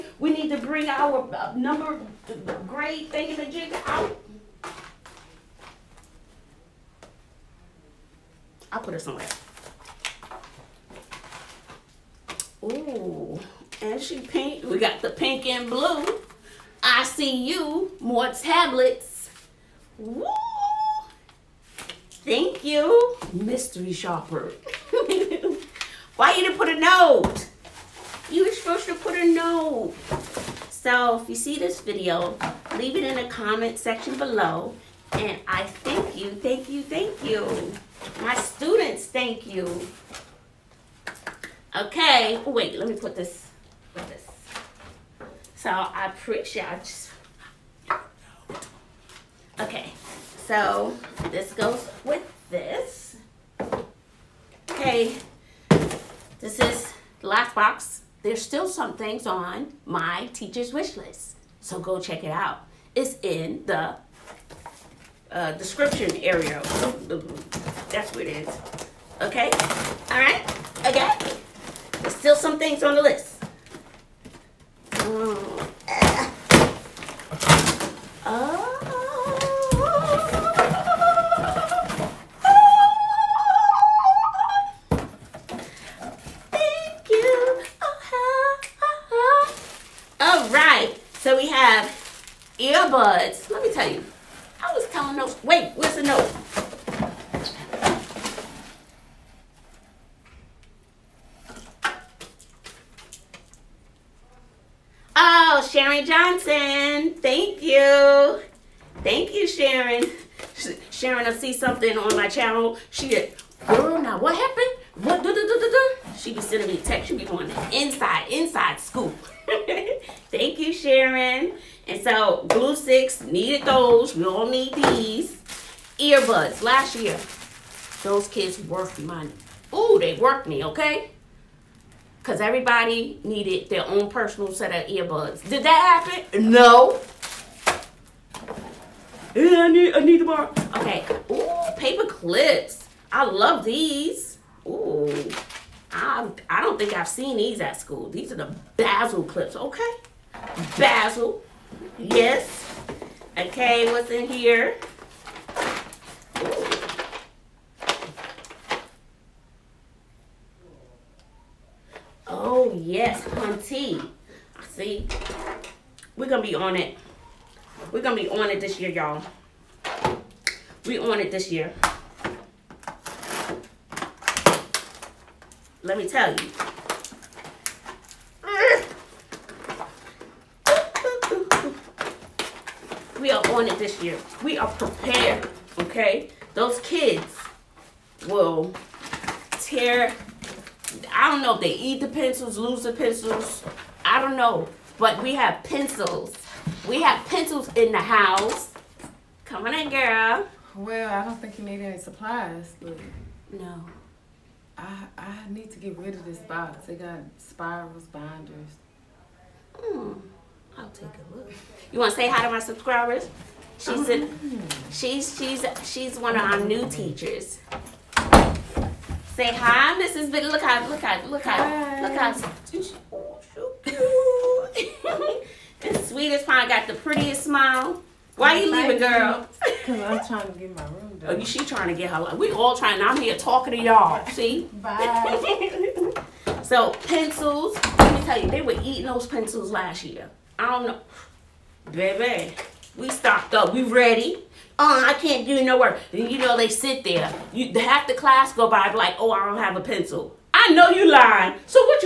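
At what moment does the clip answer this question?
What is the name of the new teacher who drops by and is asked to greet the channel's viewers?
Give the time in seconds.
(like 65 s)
220 s.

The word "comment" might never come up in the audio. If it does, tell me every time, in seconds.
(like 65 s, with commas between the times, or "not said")
33 s.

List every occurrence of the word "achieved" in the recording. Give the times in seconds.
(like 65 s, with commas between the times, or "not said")
not said.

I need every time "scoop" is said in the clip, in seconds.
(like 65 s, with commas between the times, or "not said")
118 s.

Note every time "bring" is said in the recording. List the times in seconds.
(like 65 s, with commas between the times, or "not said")
0 s.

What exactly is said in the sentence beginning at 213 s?
She's a, oh, she's she's she's one of our new teachers.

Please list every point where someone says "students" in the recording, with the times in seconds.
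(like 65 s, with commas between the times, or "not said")
38 s.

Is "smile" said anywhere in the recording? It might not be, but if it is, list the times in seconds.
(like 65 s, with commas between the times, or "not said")
227 s.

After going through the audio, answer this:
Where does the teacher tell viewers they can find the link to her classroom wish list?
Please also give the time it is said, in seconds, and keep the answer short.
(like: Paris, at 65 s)
description area, at 65 s.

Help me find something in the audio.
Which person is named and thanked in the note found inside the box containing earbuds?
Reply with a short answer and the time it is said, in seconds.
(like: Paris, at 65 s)
Sharon Johnson, at 105 s.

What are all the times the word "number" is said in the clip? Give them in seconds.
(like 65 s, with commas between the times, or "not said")
1 s.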